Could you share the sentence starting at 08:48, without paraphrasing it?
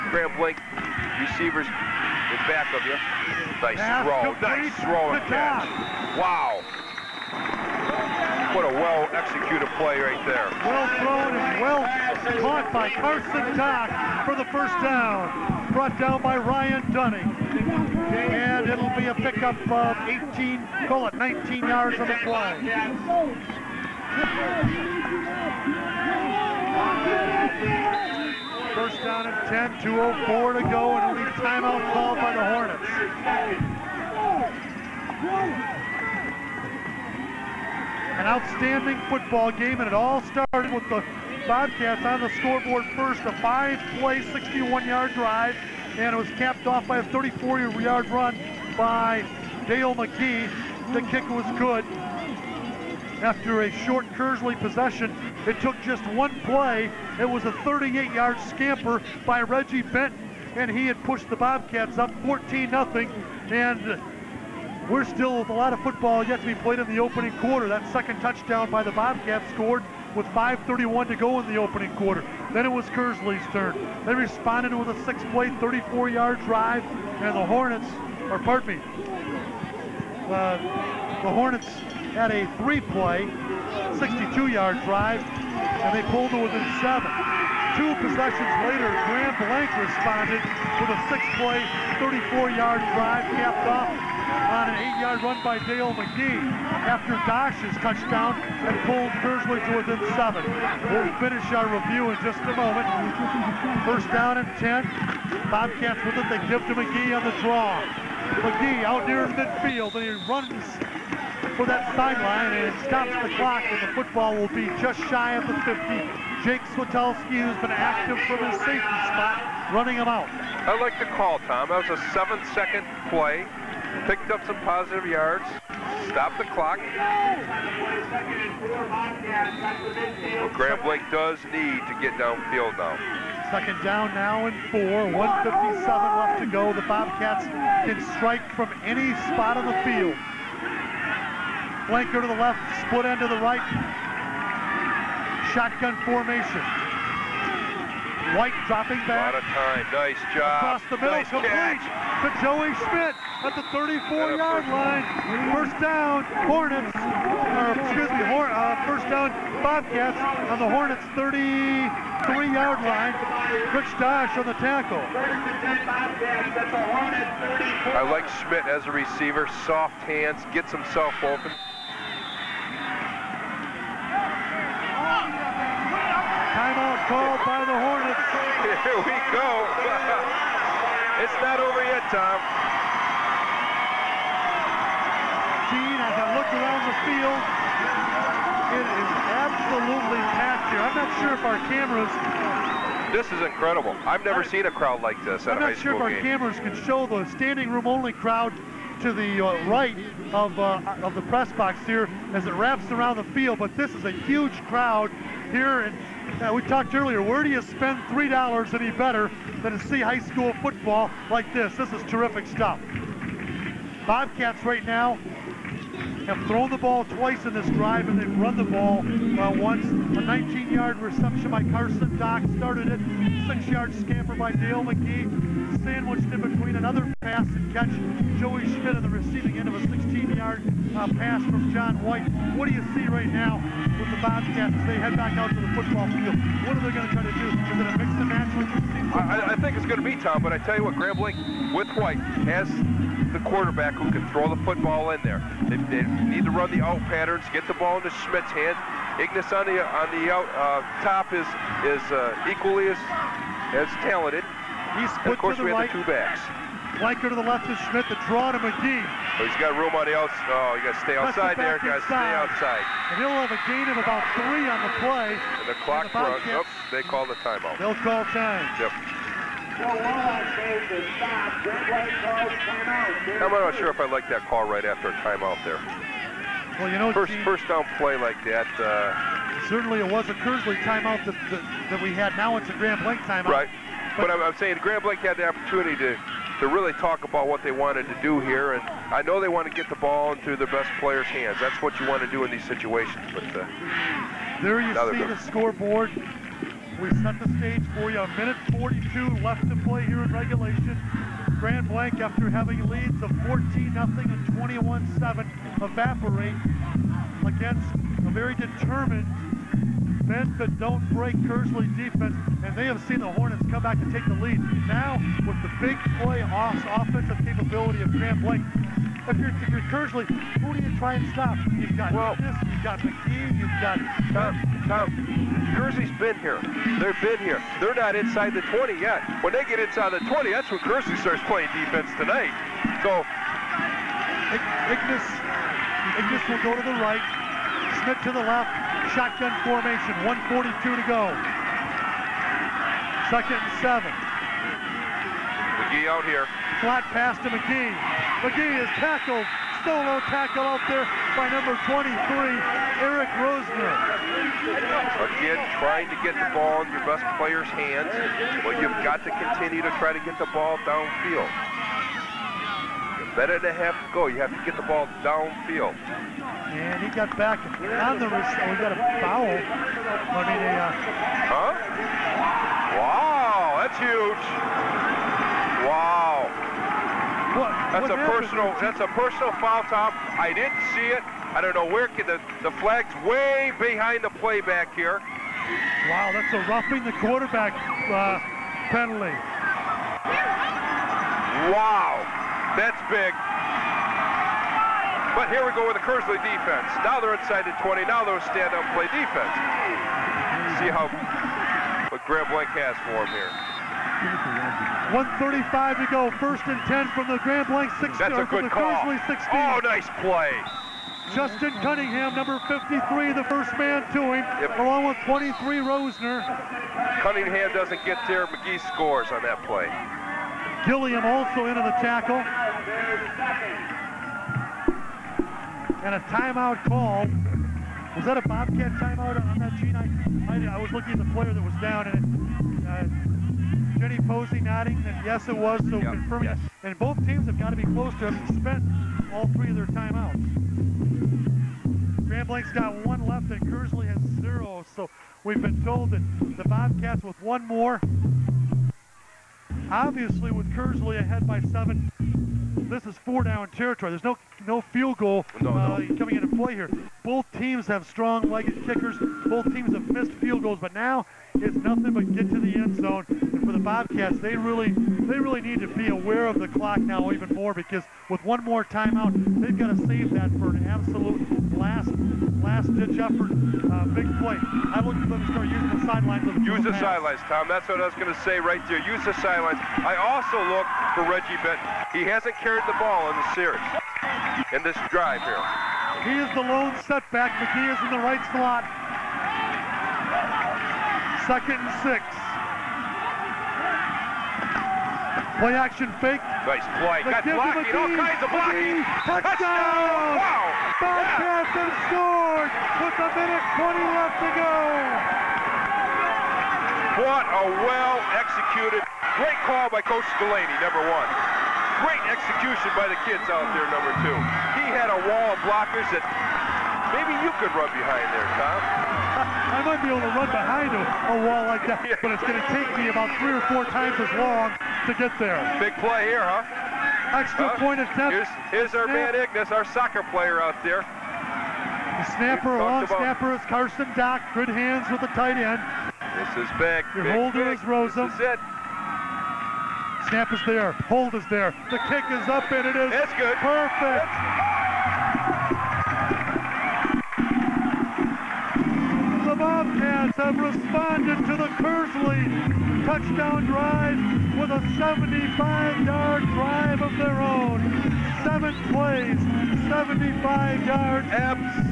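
Here's, here's our man Ignis, our soccer player out there.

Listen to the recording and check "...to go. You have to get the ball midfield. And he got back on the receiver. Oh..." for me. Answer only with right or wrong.
wrong.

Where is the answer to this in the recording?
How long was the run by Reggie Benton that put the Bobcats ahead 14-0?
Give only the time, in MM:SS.
00:57.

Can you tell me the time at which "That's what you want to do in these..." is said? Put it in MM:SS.
04:51.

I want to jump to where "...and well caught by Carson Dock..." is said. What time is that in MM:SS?
00:11.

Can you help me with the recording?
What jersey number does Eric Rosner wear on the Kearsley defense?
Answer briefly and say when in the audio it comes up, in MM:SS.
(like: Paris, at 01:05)
23, at 05:51.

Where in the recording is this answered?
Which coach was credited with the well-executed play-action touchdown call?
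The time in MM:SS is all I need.
08:30.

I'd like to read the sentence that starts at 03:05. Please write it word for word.
Gene, as I look around the field, it is absolutely packed here.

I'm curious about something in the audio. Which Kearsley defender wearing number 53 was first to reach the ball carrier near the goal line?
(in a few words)
Justin Cunningham.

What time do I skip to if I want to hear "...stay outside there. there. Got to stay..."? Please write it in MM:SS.
04:21.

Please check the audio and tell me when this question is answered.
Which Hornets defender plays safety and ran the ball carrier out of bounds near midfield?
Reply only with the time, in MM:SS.
01:56.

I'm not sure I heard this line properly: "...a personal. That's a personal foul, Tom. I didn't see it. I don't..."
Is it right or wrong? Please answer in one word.
right.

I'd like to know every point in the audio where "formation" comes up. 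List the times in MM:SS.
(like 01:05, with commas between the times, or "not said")
02:26, 05:39.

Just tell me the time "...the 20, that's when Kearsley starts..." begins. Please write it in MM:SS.
05:30.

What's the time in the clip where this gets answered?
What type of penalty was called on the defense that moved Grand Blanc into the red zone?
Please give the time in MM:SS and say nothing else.
06:26.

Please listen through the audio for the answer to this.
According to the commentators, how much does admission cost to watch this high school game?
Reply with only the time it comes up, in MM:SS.
03:28.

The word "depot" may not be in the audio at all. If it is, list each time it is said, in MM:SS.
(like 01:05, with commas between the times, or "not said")
not said.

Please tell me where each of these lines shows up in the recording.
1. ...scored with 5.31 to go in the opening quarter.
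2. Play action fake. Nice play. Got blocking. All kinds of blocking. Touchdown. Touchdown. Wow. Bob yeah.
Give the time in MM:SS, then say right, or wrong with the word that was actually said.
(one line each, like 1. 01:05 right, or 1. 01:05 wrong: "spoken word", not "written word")
1. 01:09 right
2. 08:15 right.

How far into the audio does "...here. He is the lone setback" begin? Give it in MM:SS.
08:05.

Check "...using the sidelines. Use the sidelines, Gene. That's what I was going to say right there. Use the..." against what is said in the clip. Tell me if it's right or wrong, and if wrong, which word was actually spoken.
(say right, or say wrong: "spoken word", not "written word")
wrong: "Tom", not "Gene".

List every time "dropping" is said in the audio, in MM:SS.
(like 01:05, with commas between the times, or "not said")
02:28.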